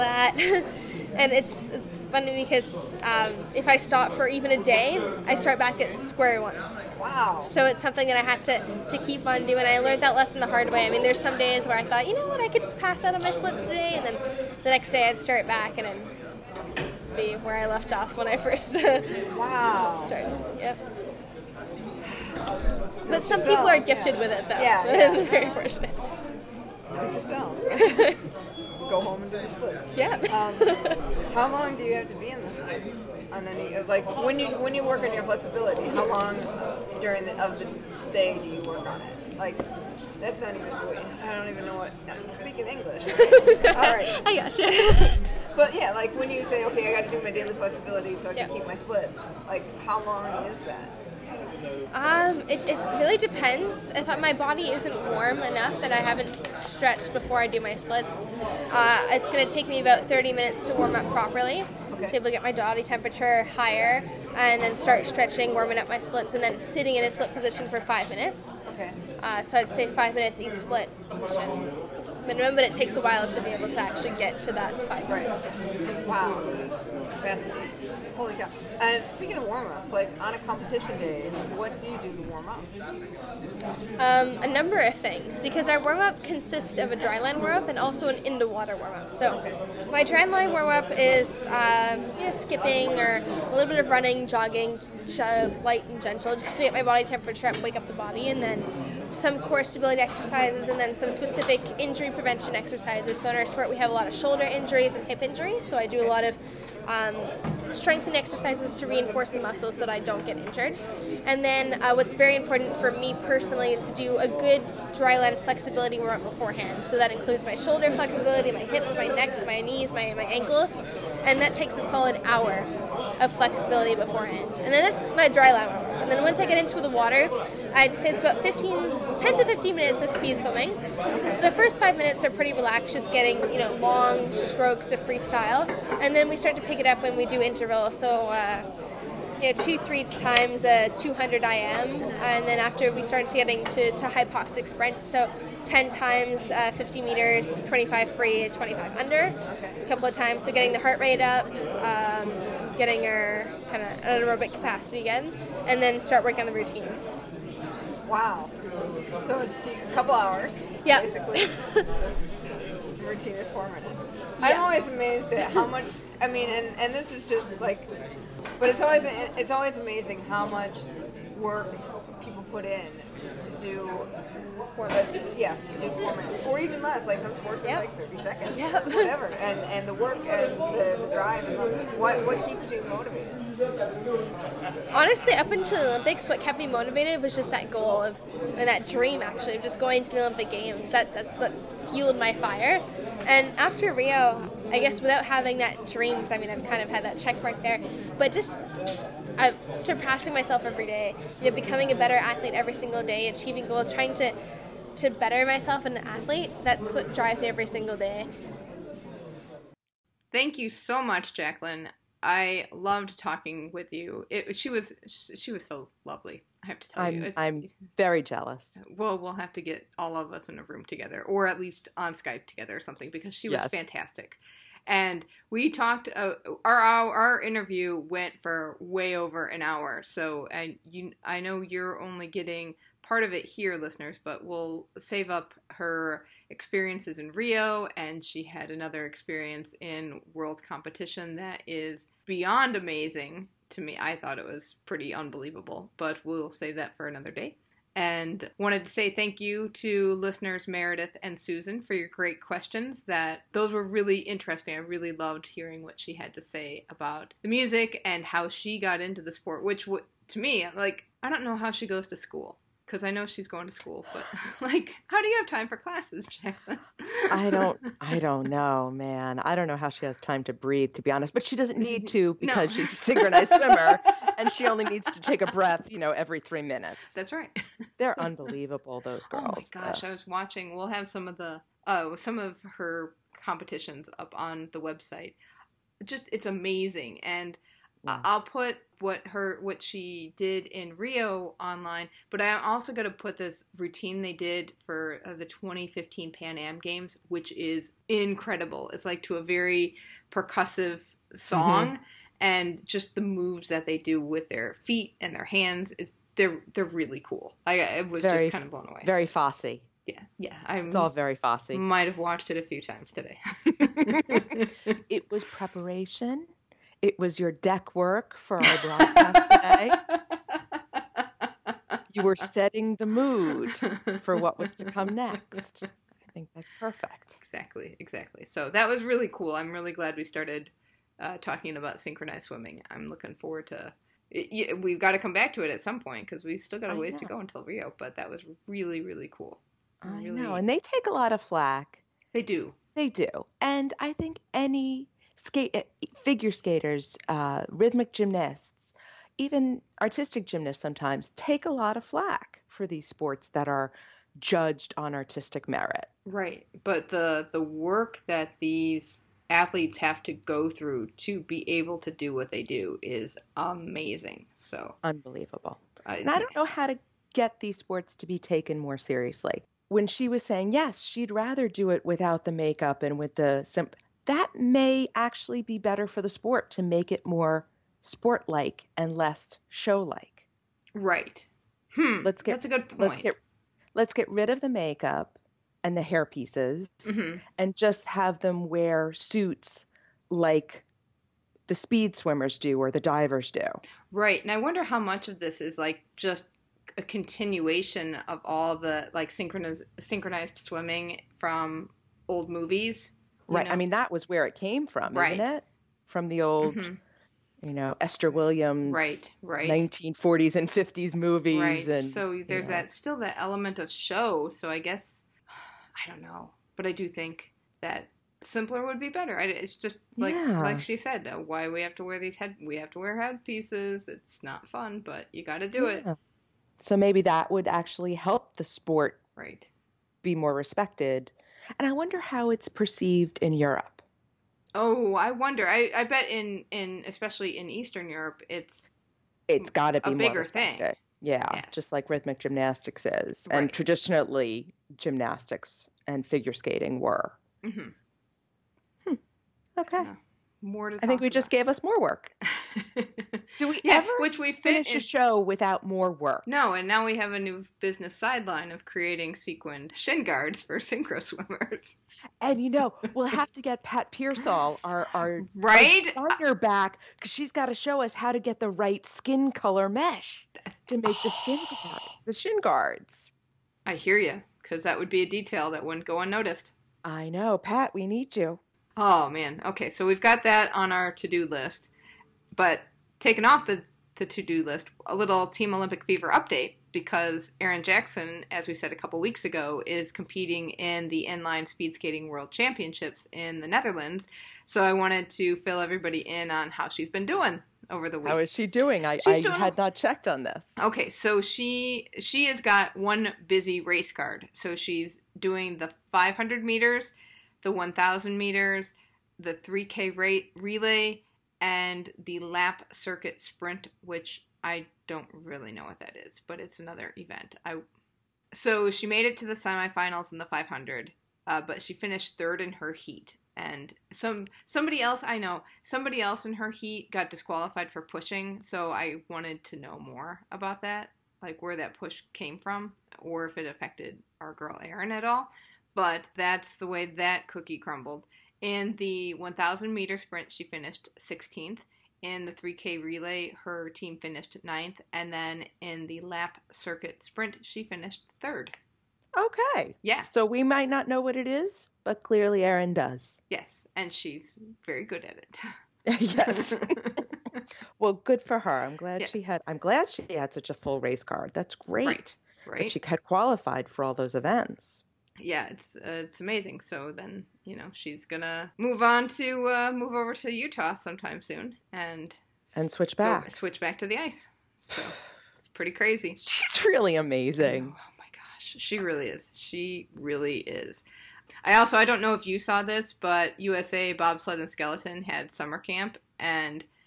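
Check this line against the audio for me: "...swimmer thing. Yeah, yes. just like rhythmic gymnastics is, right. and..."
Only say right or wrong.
wrong.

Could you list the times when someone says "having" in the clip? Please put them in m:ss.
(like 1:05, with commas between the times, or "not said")
3:15.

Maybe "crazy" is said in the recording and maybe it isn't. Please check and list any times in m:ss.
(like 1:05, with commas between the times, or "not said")
9:35.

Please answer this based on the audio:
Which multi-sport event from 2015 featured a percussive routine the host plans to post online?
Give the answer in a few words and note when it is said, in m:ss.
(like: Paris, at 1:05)
Pan Am Games, at 4:56.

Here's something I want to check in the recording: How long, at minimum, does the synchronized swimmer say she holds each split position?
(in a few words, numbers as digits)
5 minutes.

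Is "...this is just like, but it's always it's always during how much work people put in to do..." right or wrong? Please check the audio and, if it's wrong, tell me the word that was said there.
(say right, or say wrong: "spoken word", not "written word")
wrong: "amazing", not "during".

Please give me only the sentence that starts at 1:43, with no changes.
So in our sport, we have a lot of shoulder injuries and hip injuries.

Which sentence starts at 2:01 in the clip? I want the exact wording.
And that takes a solid hour of flexibility beforehand.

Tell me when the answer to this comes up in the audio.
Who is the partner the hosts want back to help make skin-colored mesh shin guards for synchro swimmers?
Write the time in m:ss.
7:43.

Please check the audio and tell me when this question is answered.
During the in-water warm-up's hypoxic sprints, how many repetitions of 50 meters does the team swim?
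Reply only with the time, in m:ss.
2:25.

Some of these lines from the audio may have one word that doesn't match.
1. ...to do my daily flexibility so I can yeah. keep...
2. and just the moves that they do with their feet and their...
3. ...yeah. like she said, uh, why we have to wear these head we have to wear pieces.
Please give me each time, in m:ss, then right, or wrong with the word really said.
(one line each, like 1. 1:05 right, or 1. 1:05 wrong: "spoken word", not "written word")
1. 0:47 right
2. 5:02 right
3. 7:00 wrong: "headpieces", not "pieces".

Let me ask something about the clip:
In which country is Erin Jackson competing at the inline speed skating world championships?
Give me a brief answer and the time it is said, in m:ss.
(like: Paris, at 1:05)
Netherlands, at 8:13.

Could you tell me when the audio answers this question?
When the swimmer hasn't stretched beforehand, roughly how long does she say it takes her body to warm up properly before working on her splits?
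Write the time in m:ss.
1:00.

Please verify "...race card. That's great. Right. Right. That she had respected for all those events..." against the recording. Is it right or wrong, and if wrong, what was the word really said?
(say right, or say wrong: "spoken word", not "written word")
wrong: "qualified", not "respected".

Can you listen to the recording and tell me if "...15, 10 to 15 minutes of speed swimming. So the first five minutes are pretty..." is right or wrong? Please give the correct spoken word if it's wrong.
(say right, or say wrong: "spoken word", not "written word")
right.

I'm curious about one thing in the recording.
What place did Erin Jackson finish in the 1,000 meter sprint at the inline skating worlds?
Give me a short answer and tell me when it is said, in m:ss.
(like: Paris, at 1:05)
16th, at 9:01.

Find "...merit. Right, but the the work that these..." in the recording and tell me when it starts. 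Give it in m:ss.
5:55.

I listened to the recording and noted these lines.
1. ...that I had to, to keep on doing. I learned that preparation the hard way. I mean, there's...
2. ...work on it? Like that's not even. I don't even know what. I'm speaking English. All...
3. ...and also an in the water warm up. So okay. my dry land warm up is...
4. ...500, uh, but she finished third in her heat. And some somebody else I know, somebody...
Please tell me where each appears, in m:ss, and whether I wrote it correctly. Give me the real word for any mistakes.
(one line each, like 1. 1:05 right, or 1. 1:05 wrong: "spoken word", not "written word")
1. 0:08 wrong: "lesson", not "preparation"
2. 0:38 right
3. 1:27 right
4. 8:40 right.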